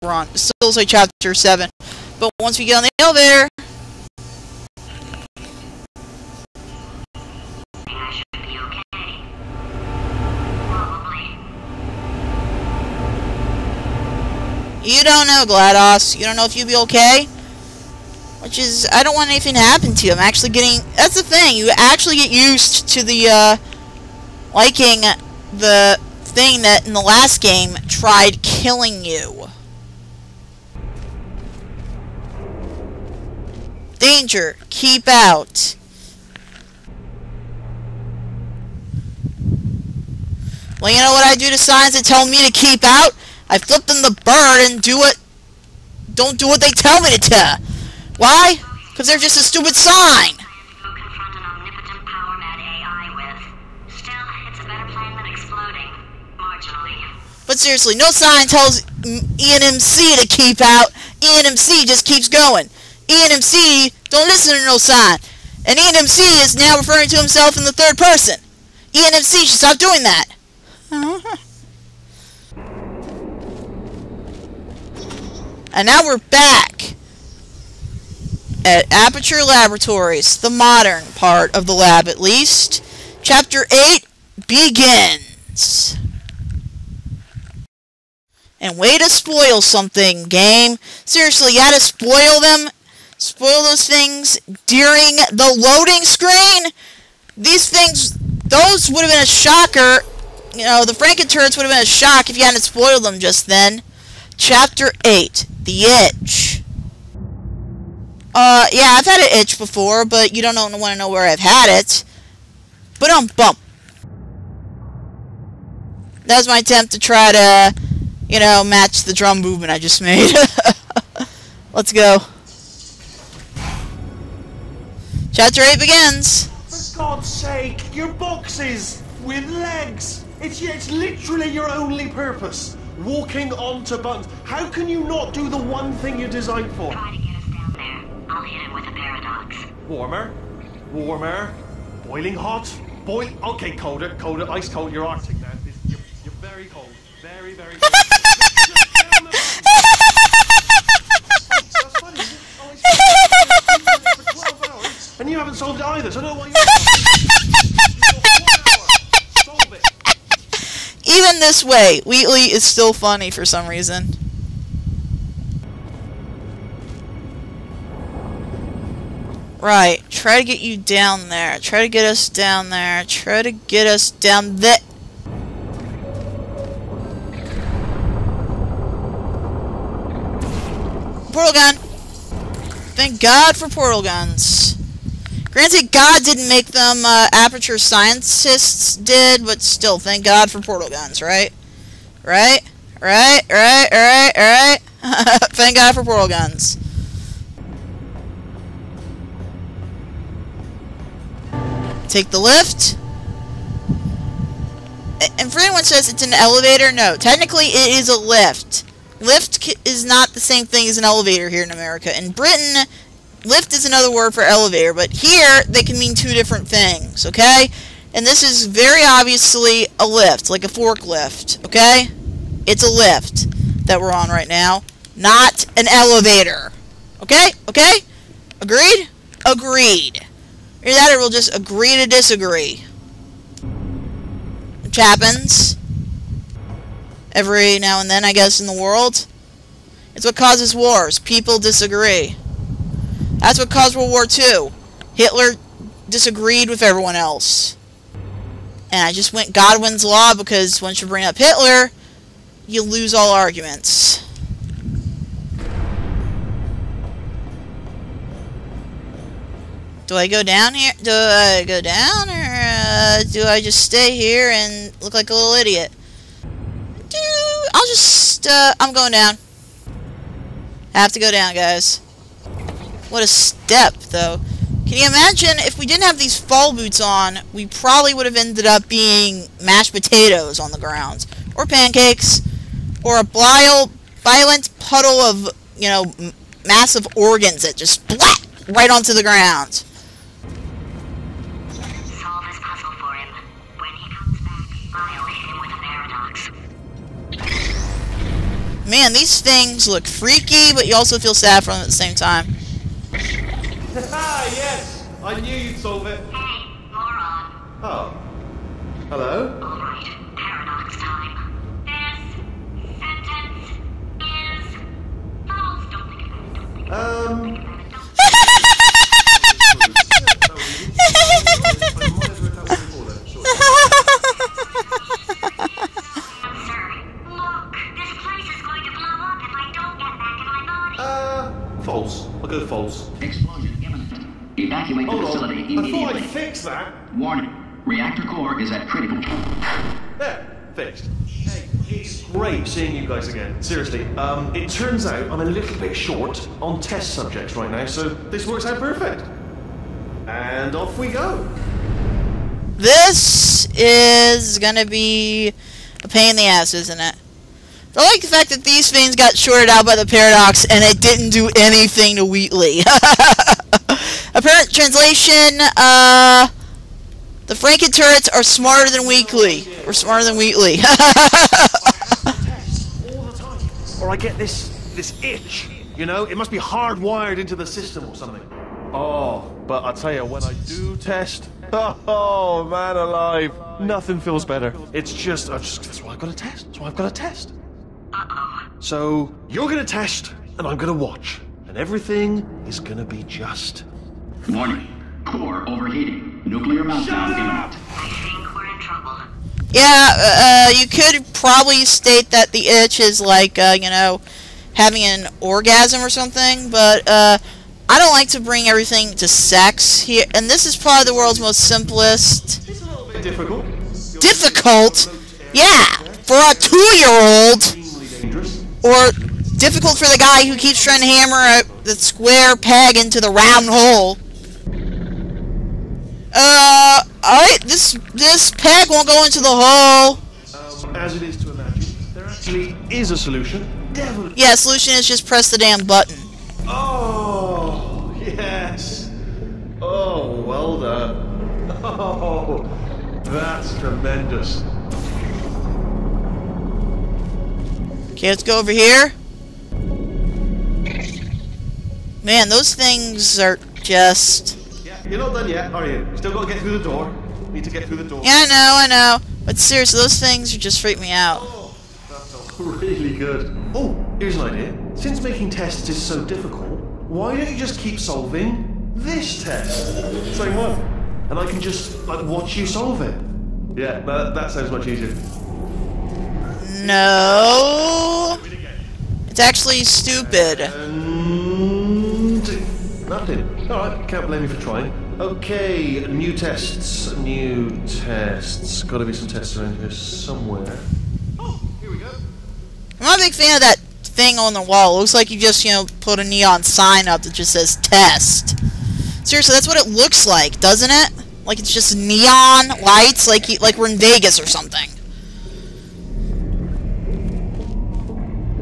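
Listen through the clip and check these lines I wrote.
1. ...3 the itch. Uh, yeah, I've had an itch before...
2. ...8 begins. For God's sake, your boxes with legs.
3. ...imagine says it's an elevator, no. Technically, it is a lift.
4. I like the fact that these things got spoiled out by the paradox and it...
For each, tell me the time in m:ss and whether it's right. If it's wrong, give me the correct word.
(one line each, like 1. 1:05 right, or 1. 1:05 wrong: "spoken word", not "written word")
1. 1:45 wrong: "8", not "3"
2. 2:05 right
3. 3:25 wrong: "anyone", not "imagine"
4. 5:57 wrong: "shorted", not "spoiled".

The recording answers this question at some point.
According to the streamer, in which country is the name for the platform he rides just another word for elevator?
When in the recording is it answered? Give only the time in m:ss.
3:32.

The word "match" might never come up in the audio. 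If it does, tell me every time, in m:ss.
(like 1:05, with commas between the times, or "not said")
1:58.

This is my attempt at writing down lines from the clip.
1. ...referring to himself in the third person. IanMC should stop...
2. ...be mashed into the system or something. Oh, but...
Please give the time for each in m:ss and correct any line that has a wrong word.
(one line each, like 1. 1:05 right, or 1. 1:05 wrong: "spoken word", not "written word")
1. 1:06 right
2. 6:16 wrong: "hardwired", not "mashed".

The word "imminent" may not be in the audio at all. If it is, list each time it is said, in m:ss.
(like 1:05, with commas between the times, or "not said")
6:37.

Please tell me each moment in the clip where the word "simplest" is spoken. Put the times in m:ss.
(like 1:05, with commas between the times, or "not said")
6:51.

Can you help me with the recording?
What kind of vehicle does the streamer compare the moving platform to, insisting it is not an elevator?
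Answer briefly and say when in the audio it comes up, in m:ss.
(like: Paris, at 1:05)
forklift, at 3:40.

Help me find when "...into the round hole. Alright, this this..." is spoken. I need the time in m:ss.
7:02.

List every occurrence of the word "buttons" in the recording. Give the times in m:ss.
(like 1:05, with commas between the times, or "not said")
2:14, 7:15.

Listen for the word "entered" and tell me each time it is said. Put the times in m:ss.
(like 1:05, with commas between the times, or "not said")
not said.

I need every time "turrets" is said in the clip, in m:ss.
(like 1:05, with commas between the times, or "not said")
1:41, 6:07.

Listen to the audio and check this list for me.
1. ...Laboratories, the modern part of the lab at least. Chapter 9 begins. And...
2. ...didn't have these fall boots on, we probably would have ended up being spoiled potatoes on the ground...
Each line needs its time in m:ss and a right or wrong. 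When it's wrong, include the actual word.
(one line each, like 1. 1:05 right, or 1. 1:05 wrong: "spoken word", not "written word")
1. 1:19 wrong: "8", not "9"
2. 4:35 wrong: "mashed", not "spoiled".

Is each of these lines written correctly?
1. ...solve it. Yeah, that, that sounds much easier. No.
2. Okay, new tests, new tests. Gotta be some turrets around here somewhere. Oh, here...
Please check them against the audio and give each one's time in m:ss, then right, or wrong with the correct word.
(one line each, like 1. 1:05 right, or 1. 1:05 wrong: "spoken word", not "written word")
1. 7:52 right
2. 8:05 wrong: "tests", not "turrets".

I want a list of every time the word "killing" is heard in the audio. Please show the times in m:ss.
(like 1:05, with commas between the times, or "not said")
0:28.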